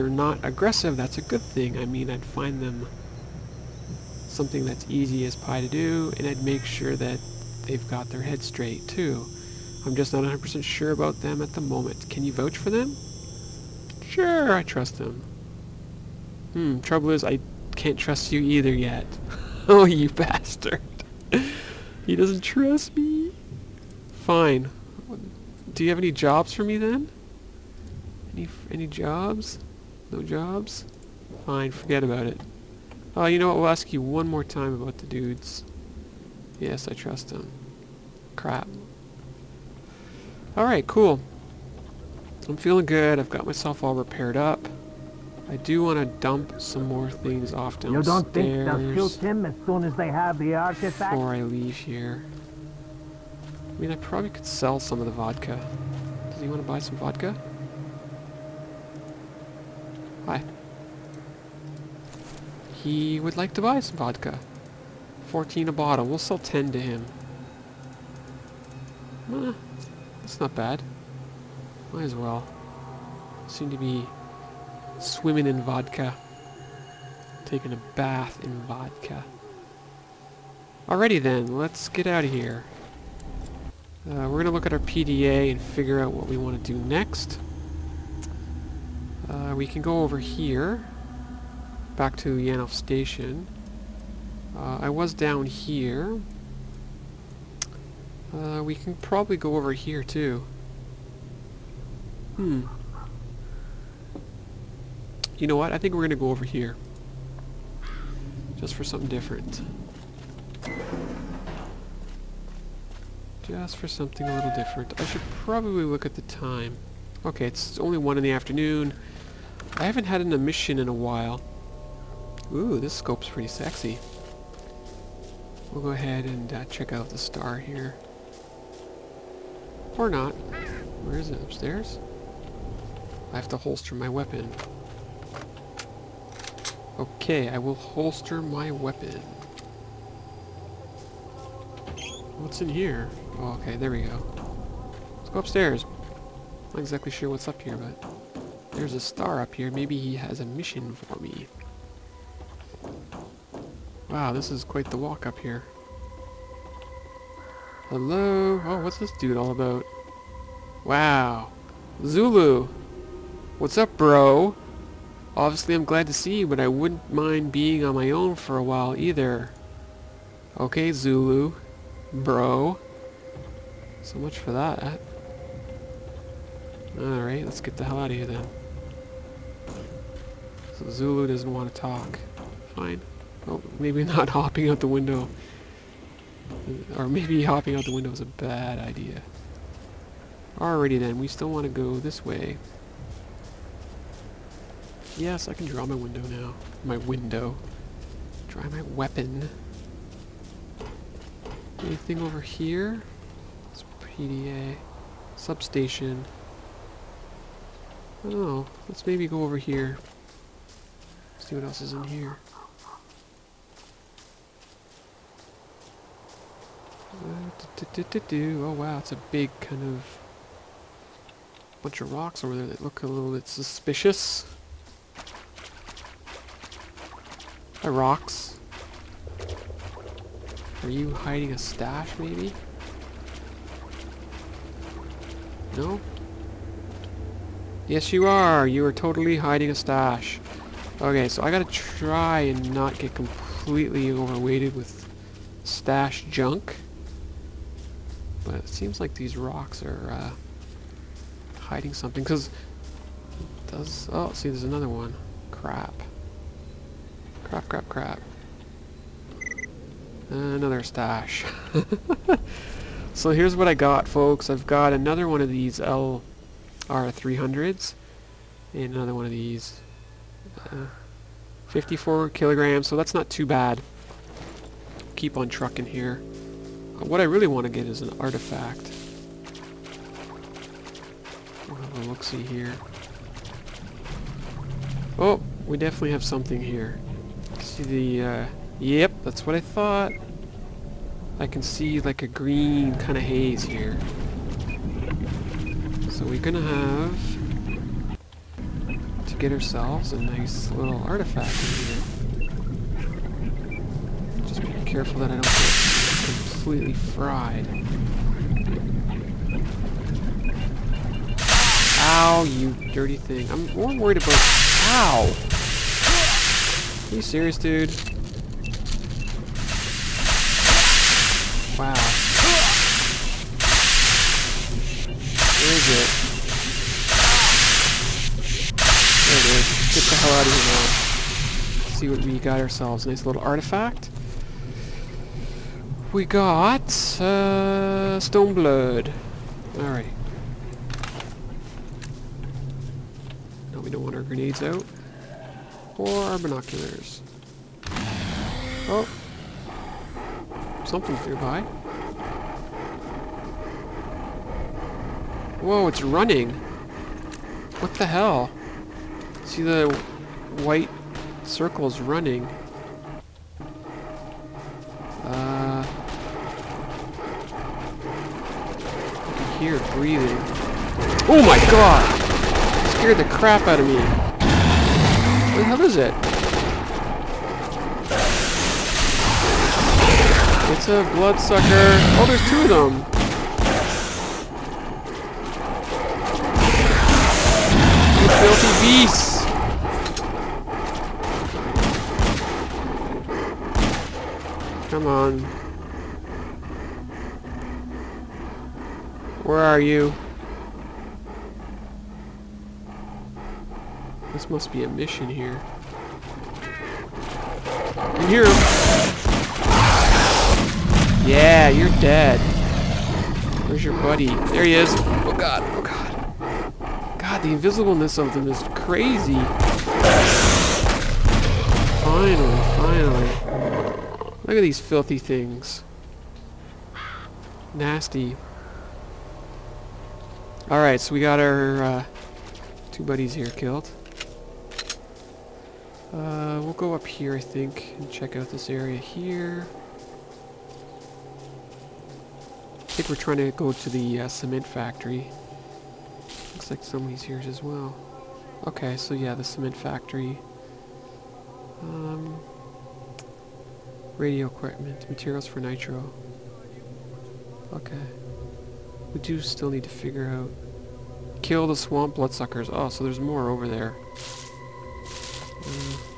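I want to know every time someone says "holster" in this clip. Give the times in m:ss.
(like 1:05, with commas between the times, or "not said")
2:13, 2:17.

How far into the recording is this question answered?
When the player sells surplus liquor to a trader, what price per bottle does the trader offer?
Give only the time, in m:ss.
1:05.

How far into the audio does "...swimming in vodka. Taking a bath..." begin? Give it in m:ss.
1:14.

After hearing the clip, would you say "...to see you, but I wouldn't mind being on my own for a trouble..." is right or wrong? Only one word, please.
wrong.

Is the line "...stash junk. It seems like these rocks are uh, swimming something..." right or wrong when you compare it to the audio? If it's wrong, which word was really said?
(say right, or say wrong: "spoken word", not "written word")
wrong: "hiding", not "swimming".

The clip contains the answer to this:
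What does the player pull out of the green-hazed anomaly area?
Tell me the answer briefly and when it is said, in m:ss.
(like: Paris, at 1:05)
blood, at 5:38.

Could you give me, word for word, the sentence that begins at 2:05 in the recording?
We'll go ahead and uh, check out the star here.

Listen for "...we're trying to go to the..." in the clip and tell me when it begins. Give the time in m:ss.
7:23.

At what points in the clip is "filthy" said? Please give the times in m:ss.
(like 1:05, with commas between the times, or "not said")
6:34, 7:04.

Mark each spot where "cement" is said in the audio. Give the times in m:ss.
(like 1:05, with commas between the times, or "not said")
7:24, 7:29.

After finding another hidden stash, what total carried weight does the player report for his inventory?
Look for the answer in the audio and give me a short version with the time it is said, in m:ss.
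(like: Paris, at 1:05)
54 kilograms, at 4:31.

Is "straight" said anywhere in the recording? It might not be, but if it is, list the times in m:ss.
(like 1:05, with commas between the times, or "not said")
0:08.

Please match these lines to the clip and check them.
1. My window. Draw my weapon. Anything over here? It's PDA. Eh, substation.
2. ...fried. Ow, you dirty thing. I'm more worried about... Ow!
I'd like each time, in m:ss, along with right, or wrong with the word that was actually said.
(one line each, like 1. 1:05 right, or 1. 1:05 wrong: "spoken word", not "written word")
1. 3:16 right
2. 5:06 right.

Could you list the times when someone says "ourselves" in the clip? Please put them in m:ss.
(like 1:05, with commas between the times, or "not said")
4:59, 5:32.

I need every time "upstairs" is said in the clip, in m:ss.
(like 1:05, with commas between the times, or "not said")
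2:11, 2:25.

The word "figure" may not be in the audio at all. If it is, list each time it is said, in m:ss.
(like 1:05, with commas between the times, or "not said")
1:25, 7:39.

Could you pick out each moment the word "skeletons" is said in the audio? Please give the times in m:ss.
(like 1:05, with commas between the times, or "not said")
not said.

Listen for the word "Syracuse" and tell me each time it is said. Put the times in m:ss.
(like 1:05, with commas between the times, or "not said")
not said.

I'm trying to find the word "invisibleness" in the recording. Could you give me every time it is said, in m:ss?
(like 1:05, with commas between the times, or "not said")
6:57.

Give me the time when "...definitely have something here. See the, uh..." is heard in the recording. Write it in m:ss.
4:45.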